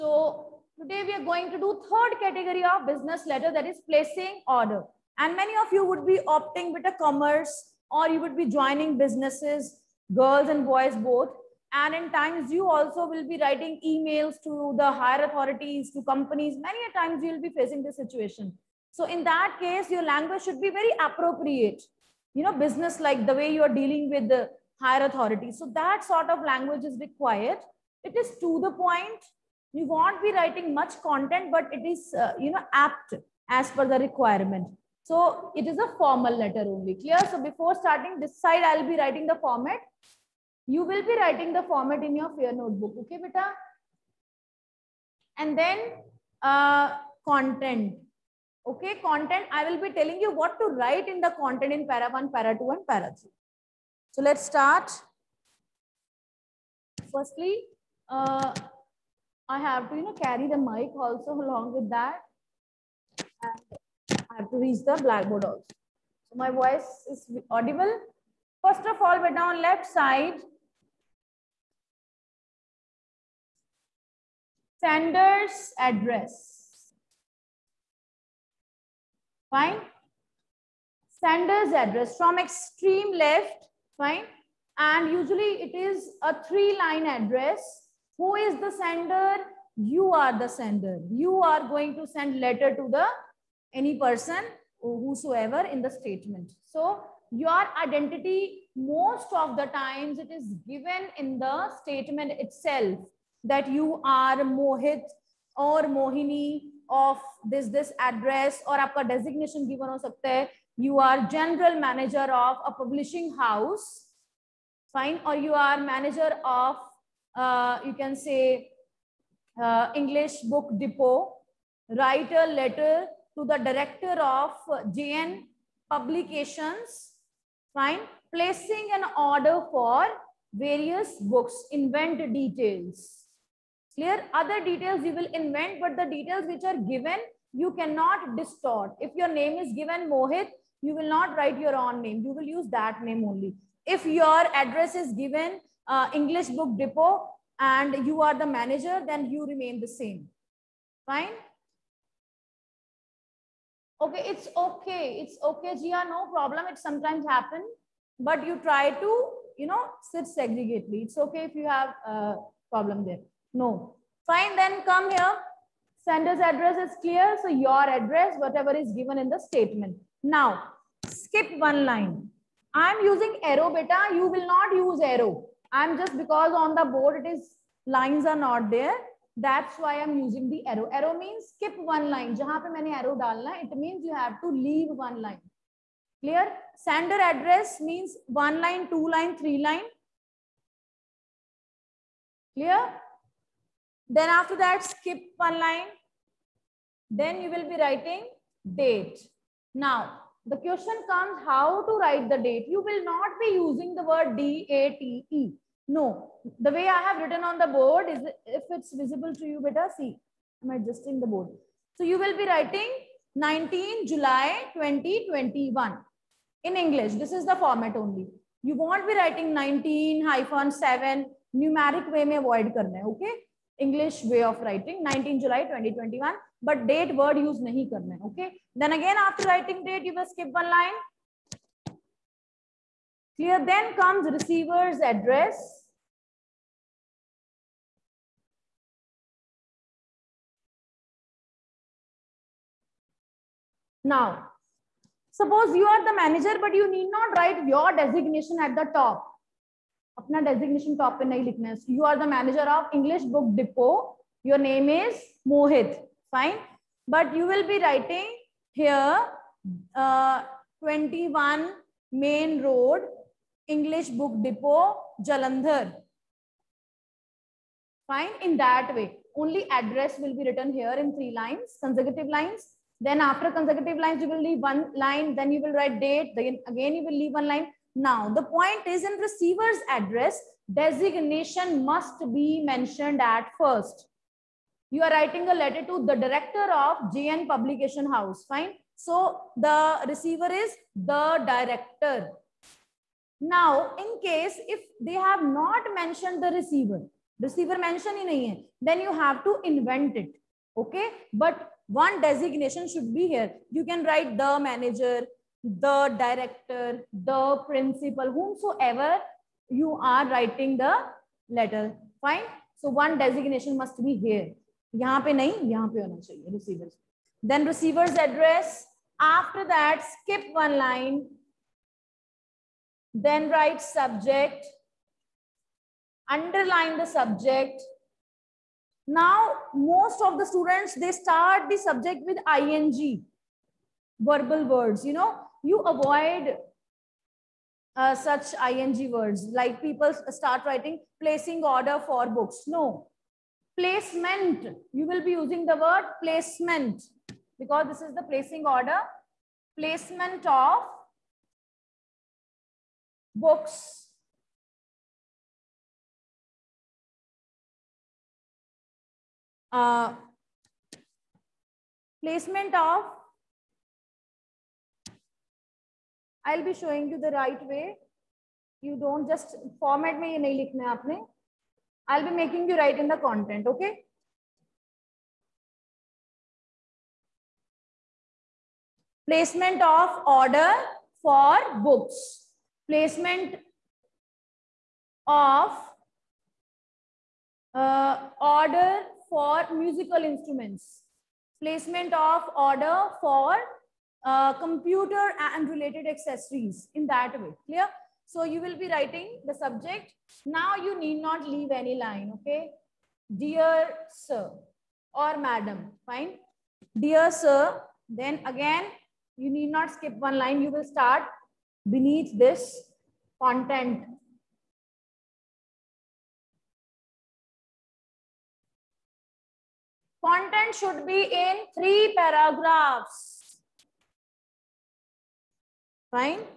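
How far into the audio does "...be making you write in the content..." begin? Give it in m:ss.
6:12.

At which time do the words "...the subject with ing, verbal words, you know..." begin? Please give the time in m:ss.
5:31.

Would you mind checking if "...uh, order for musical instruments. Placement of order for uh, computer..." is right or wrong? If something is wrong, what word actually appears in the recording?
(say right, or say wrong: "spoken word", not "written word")
right.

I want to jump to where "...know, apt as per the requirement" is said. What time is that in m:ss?
0:32.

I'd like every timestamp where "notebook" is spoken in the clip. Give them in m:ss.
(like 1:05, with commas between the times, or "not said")
0:42.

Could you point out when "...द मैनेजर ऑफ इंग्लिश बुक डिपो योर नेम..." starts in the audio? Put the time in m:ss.
4:12.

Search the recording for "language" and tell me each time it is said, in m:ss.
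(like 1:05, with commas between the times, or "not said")
0:20, 0:26.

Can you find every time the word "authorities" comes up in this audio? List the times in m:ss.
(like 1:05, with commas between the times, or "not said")
0:15, 0:25.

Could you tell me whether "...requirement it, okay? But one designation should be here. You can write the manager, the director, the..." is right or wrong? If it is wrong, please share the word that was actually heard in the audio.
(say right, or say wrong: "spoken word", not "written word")
wrong: "invent", not "requirement".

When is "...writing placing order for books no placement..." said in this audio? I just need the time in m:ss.
5:40.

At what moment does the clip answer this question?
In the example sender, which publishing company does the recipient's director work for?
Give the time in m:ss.
2:04.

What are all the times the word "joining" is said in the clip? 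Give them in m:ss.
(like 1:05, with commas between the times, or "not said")
0:08.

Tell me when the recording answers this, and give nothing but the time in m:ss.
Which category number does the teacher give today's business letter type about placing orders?
0:01.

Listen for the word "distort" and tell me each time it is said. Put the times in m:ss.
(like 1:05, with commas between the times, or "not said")
2:18.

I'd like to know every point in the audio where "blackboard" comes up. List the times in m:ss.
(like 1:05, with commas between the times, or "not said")
1:04.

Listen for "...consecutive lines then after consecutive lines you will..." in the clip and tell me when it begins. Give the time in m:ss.
4:31.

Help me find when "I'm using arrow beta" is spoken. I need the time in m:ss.
2:52.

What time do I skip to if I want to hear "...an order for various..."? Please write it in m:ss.
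2:08.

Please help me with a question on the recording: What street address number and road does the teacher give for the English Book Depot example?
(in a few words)
21 Main Road.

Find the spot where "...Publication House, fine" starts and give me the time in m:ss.
4:47.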